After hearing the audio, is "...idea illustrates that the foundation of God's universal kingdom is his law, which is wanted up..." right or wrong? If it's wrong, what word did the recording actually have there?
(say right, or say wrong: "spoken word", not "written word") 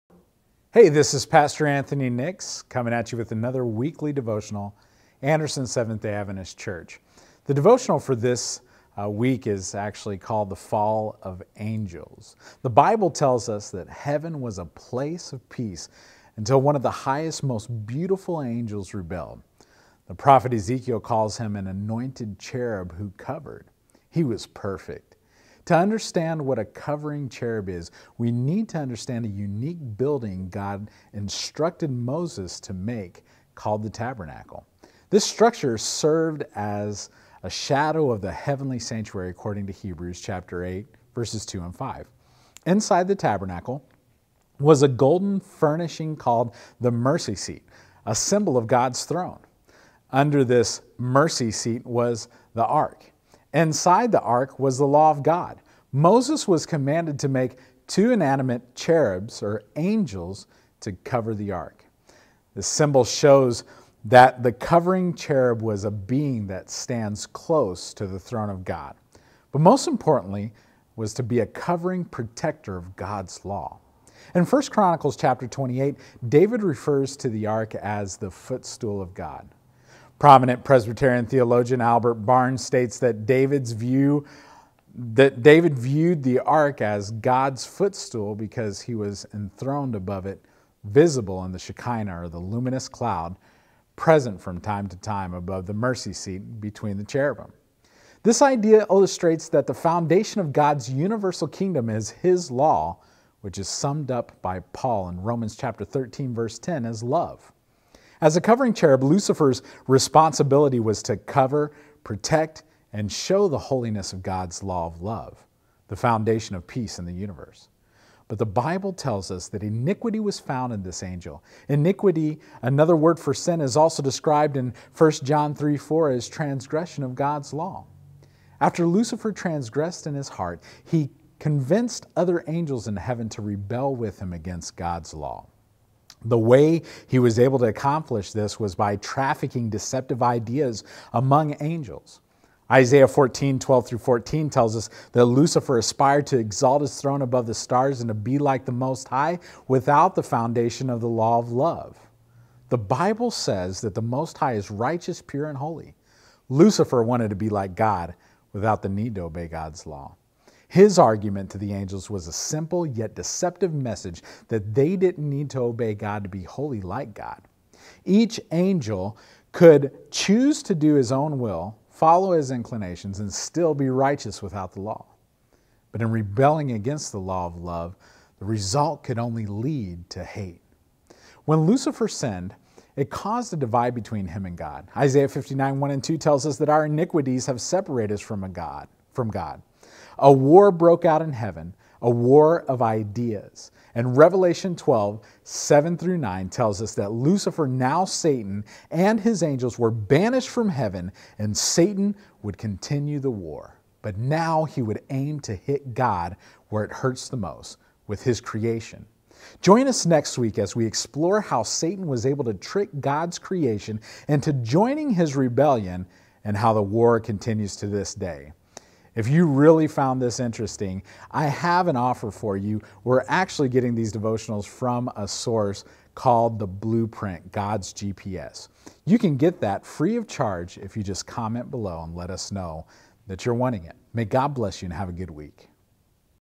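wrong: "summed", not "wanted".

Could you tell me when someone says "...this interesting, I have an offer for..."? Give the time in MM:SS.
03:40.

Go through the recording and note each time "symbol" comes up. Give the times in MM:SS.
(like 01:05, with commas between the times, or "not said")
00:48, 01:02.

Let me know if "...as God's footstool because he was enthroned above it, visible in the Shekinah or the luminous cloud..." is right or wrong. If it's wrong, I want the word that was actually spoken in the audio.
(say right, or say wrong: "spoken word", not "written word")
right.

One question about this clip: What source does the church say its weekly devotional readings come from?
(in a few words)
The Blueprint, God's GPS.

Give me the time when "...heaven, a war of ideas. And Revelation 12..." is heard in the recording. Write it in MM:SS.
03:11.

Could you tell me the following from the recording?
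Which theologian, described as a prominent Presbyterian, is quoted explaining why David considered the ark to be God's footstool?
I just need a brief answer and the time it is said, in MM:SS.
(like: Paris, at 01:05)
Albert Barnes, at 01:21.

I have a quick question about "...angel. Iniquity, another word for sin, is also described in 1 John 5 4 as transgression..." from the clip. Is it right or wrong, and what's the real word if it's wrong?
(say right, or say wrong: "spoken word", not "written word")
wrong: "3", not "5".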